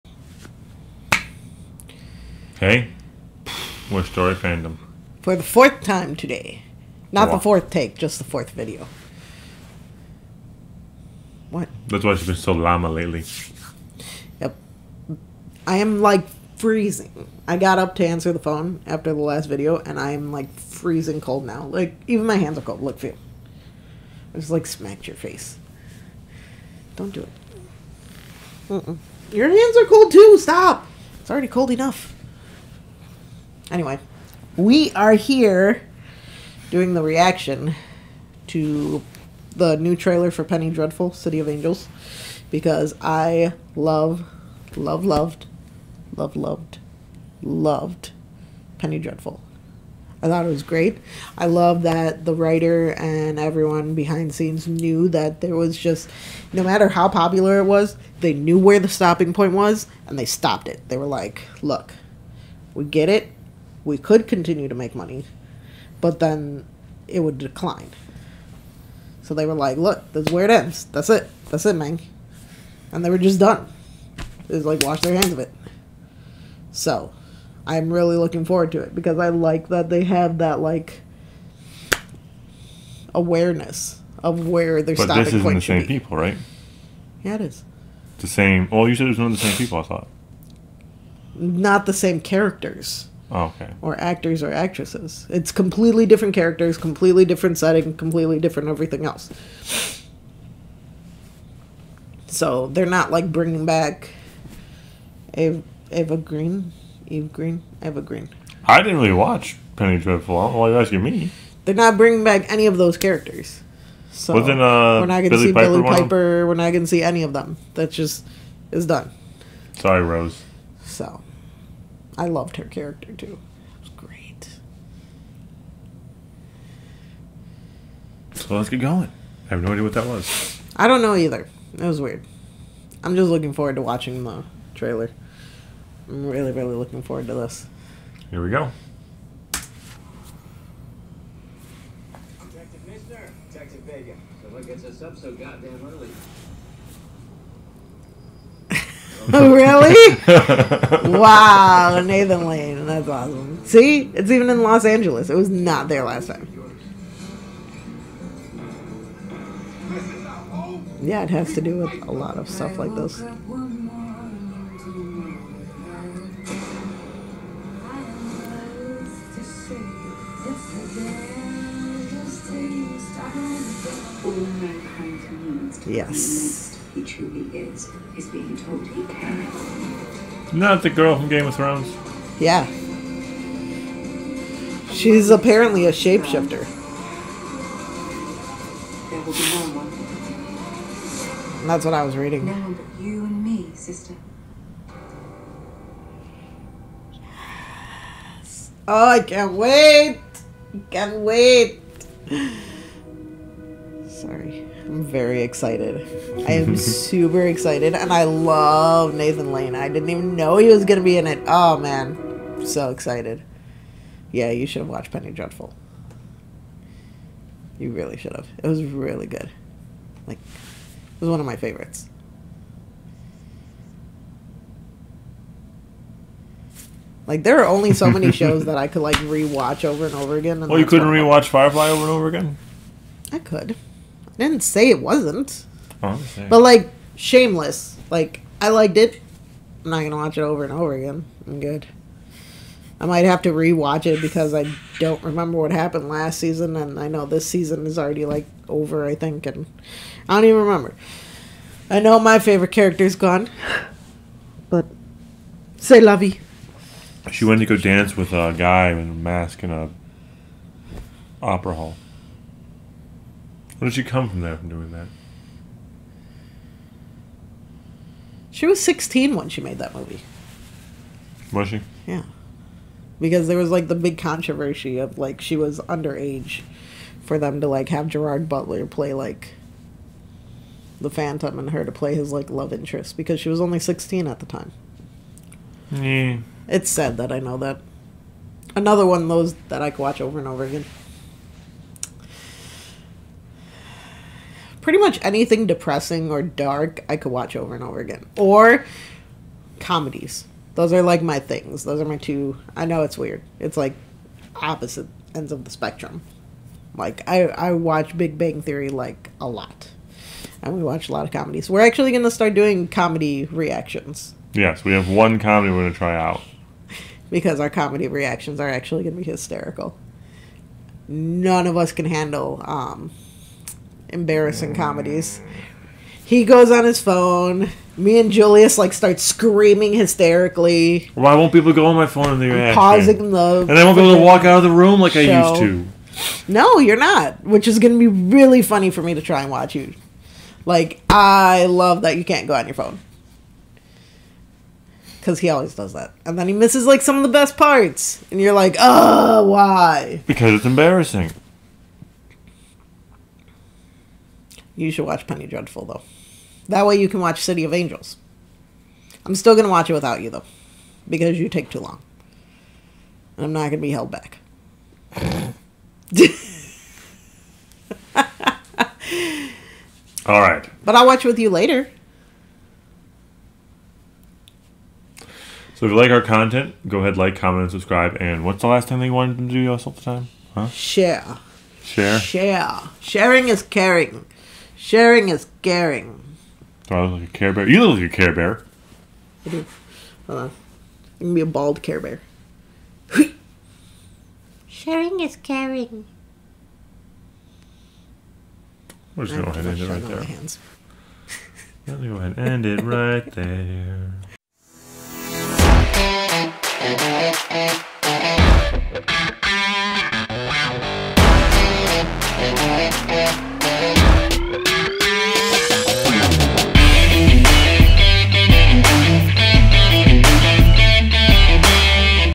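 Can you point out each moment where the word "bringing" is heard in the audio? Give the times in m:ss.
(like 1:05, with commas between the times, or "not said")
1:43, 1:51.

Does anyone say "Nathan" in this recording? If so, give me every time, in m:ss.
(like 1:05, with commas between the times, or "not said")
2:32, 3:29.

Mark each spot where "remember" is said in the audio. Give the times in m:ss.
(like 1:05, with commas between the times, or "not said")
4:05, 4:10.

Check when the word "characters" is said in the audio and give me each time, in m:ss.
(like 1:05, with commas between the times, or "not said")
1:32, 1:36, 1:52, 2:02, 4:12.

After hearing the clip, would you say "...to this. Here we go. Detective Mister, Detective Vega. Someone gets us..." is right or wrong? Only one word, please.
right.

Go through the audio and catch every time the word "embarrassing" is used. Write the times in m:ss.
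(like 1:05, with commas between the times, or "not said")
5:24, 5:50.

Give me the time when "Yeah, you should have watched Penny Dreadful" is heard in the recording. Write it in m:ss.
3:34.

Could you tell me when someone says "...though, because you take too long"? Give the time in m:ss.
6:00.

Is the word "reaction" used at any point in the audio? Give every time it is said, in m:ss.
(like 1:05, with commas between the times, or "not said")
0:37, 5:13, 5:18, 5:32.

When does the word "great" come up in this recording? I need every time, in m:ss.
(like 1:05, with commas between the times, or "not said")
0:50, 2:03.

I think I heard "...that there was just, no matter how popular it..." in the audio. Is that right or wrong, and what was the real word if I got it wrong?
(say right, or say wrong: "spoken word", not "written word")
right.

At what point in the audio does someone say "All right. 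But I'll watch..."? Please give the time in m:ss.
6:10.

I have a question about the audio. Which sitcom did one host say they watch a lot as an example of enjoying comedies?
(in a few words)
Big Bang Theory.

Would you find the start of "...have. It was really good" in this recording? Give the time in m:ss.
3:38.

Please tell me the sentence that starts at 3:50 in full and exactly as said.
And well, oh, you couldn't rewatch Firefly over and over again.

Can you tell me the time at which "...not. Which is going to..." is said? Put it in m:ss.
5:36.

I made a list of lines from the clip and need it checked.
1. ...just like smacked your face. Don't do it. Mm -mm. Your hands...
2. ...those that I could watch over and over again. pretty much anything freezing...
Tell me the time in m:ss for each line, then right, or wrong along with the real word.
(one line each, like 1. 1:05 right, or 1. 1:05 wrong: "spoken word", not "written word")
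1. 0:24 right
2. 4:49 wrong: "depressing", not "freezing".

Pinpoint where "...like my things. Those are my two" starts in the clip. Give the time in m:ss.
5:01.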